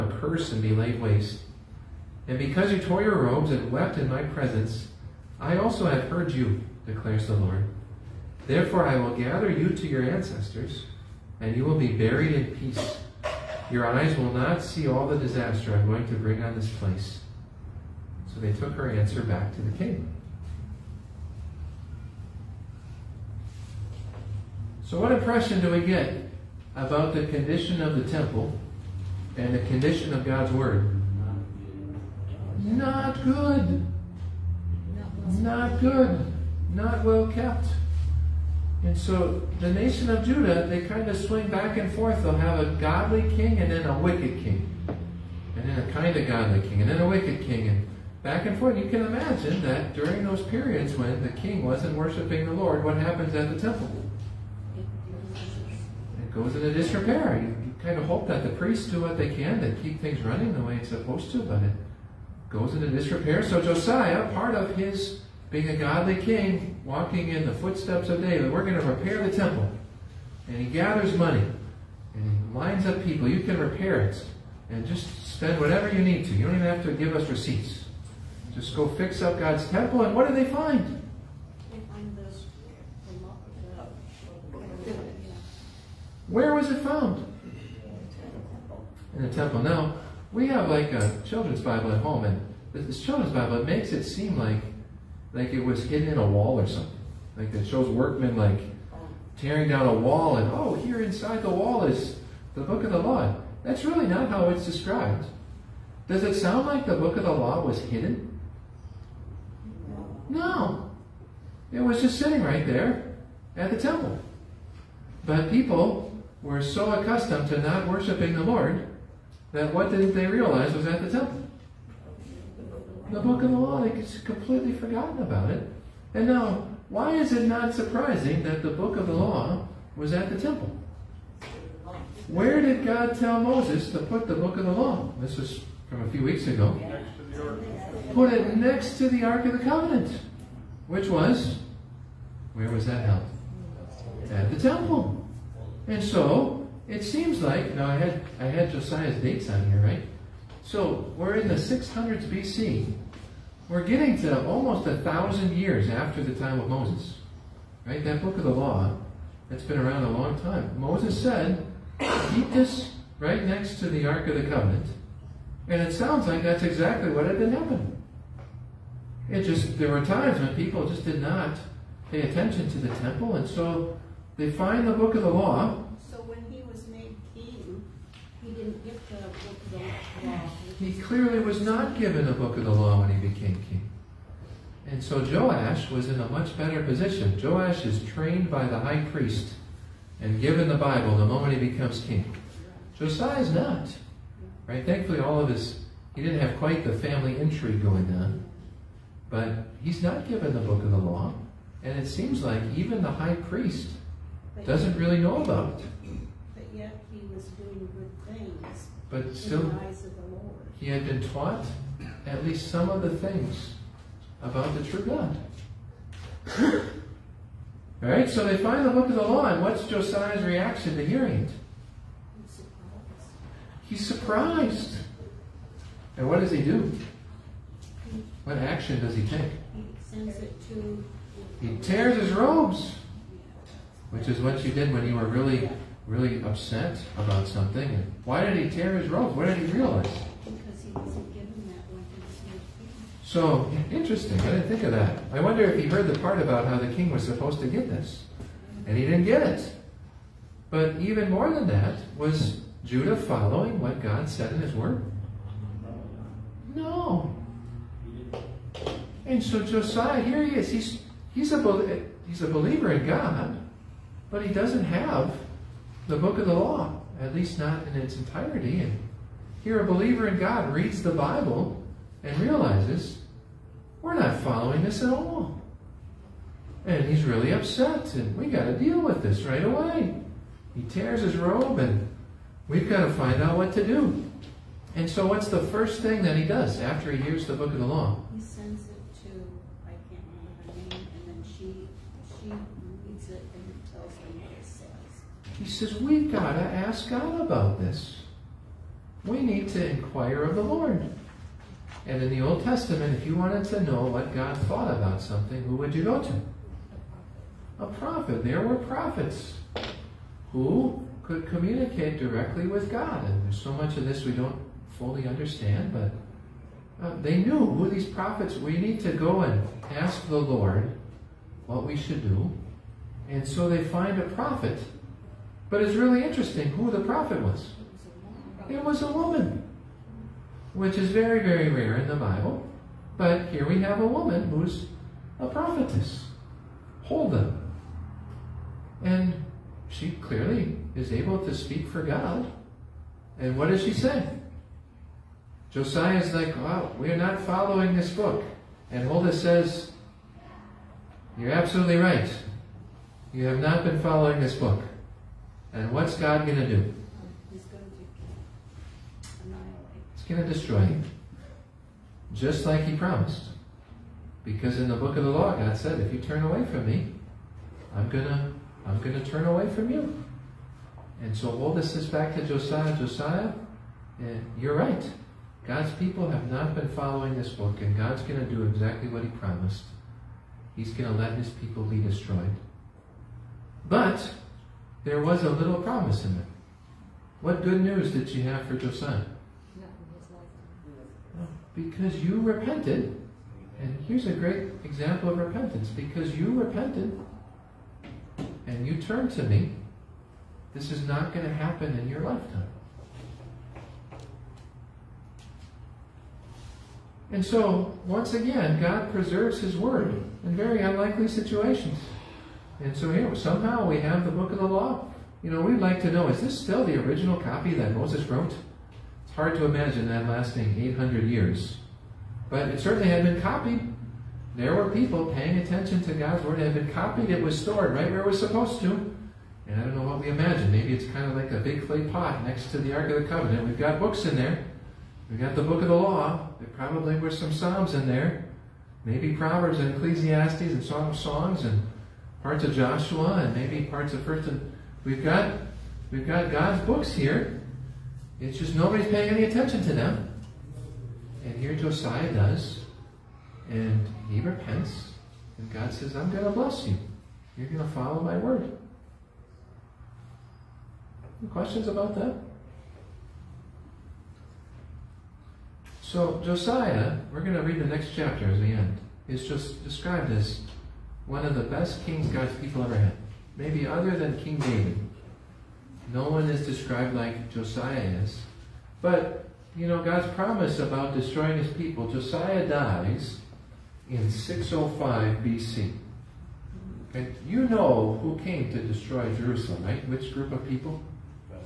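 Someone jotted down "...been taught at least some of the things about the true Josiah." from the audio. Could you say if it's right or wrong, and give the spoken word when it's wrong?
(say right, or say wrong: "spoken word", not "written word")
wrong: "God", not "Josiah".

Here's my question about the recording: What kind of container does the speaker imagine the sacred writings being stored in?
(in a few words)
A big clay pot.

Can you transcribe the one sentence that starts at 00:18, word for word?
So they took her answer back to the king.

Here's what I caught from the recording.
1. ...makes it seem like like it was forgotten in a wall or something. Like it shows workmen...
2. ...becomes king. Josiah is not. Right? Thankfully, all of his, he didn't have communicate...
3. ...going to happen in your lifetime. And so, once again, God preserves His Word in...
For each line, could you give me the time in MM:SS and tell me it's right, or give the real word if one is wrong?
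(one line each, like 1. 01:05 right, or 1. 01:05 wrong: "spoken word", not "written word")
1. 01:33 wrong: "hidden", not "forgotten"
2. 03:11 wrong: "quite", not "communicate"
3. 06:41 right.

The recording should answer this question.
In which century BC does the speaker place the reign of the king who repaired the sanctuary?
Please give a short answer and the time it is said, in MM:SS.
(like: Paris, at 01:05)
600s BC, at 02:31.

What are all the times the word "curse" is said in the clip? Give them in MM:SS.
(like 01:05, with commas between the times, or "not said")
00:00.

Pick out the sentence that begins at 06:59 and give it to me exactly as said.
It's hard to imagine that lasting 800 years.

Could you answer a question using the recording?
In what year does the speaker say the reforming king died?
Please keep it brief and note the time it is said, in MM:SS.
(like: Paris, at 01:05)
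605 BC, at 08:04.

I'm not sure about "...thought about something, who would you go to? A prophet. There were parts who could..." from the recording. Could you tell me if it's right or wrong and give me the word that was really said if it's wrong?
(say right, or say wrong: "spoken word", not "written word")
wrong: "prophets", not "parts".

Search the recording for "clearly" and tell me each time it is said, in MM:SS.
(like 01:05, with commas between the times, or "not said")
03:01, 05:40.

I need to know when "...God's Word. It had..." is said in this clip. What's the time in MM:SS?
07:06.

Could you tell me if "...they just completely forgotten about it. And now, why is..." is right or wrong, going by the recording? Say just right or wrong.
right.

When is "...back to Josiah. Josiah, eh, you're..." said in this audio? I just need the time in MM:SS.
06:12.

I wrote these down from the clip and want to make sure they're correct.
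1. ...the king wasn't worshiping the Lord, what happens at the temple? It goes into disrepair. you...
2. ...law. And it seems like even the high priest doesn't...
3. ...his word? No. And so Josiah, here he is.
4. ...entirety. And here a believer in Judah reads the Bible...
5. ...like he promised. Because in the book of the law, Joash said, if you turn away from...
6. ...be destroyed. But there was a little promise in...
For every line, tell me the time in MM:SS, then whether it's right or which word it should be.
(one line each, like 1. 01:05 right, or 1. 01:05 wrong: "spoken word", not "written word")
1. 00:51 right
2. 03:20 right
3. 04:14 right
4. 04:28 wrong: "God", not "Judah"
5. 06:02 wrong: "God", not "Joash"
6. 06:21 right.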